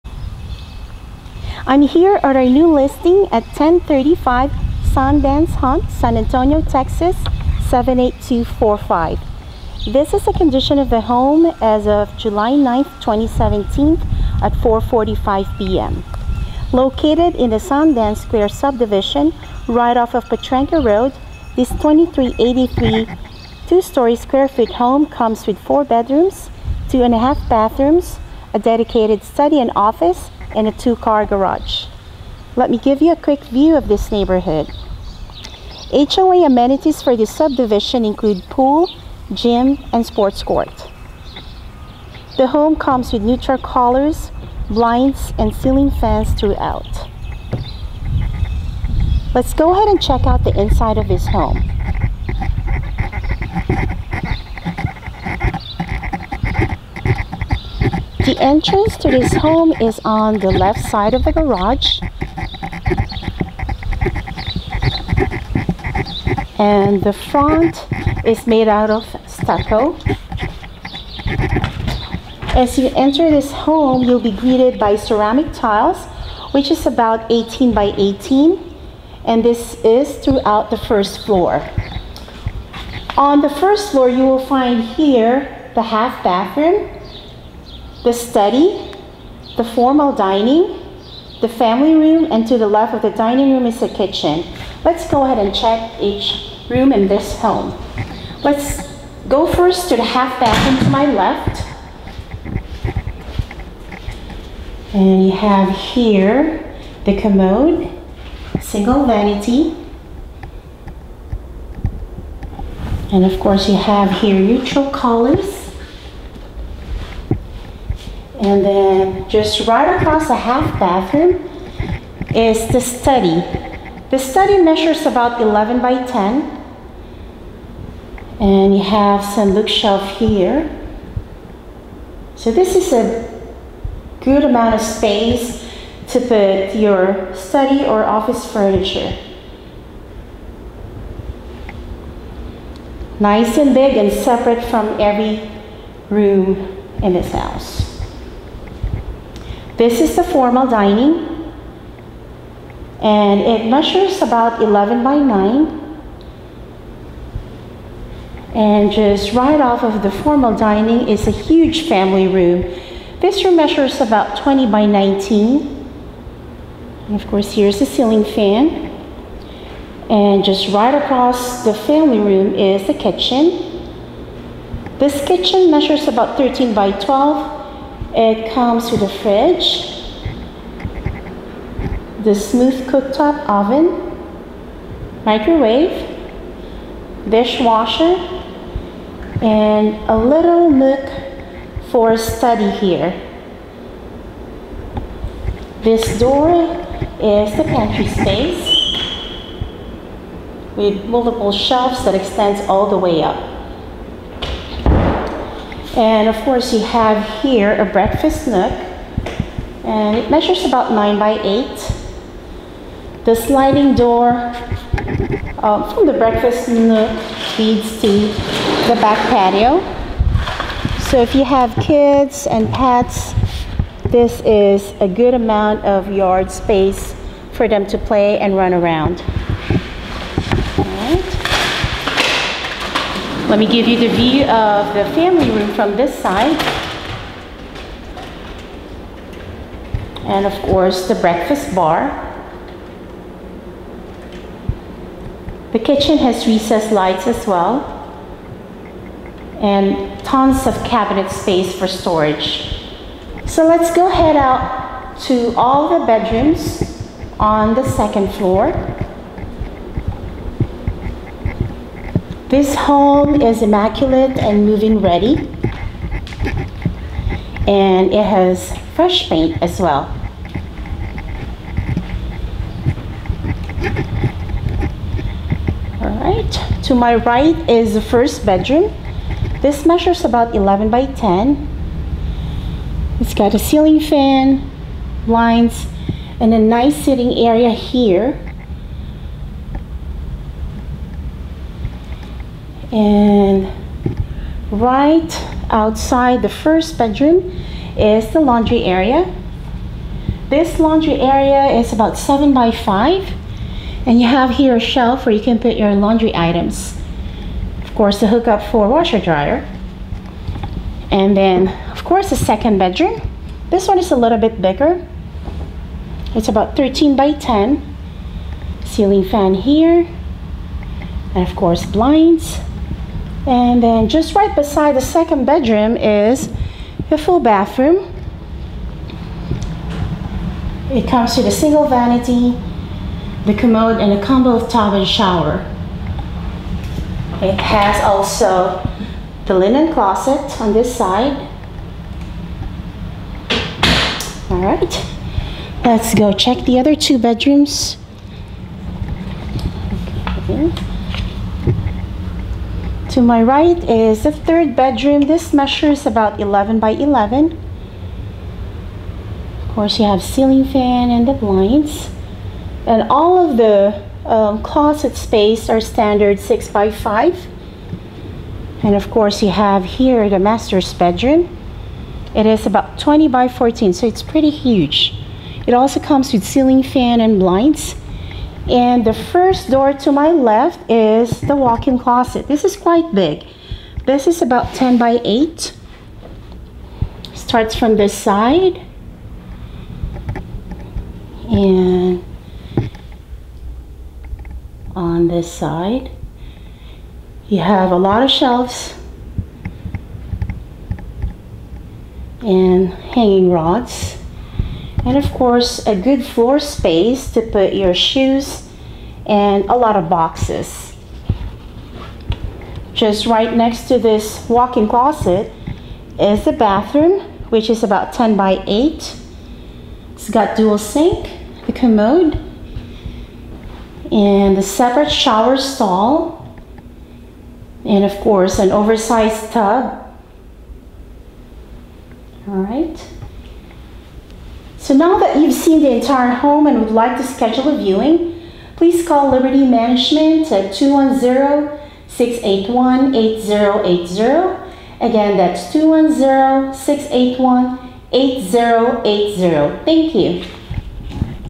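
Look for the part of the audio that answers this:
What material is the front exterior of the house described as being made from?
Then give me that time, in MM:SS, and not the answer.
01:09.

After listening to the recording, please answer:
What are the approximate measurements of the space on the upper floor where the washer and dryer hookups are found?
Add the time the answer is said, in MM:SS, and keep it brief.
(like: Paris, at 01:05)
7 by 5, at 05:02.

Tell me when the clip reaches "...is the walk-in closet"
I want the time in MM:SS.
06:20.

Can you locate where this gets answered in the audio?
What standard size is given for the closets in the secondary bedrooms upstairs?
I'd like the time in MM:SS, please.
06:06.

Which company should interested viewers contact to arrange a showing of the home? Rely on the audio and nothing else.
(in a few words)
Liberty Management.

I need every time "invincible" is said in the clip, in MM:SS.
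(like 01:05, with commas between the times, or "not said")
not said.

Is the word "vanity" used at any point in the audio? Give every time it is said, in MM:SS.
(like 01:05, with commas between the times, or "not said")
01:49, 05:31.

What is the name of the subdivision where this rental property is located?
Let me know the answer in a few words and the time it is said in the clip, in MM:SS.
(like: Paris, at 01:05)
Sundance Square, at 00:17.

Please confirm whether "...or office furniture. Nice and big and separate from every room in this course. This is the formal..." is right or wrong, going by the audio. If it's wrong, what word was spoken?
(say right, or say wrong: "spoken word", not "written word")
wrong: "house", not "course".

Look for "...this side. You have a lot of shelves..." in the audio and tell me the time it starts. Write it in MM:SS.
06:35.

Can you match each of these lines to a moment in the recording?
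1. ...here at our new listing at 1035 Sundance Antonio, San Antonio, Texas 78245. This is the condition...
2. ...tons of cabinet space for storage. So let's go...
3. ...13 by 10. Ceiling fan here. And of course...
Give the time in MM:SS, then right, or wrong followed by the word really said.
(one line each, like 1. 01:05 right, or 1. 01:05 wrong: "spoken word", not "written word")
1. 00:01 wrong: "Hunt", not "Antonio"
2. 04:10 right
3. 05:16 right.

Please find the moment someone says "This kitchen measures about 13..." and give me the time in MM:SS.
02:54.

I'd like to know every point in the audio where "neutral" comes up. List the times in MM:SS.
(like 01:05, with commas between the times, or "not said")
00:43, 01:54.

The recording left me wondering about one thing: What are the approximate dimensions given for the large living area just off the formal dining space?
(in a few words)
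20 by 19.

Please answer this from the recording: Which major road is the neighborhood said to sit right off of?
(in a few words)
Potranco Road.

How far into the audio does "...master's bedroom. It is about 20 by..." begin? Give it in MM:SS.
06:10.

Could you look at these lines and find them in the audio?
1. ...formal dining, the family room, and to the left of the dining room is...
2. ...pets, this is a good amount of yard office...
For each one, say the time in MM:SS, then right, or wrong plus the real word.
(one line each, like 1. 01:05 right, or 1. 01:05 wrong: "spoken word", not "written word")
1. 01:29 right
2. 03:42 wrong: "space", not "office".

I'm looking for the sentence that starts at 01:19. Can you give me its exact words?
And this is throughout the first floor.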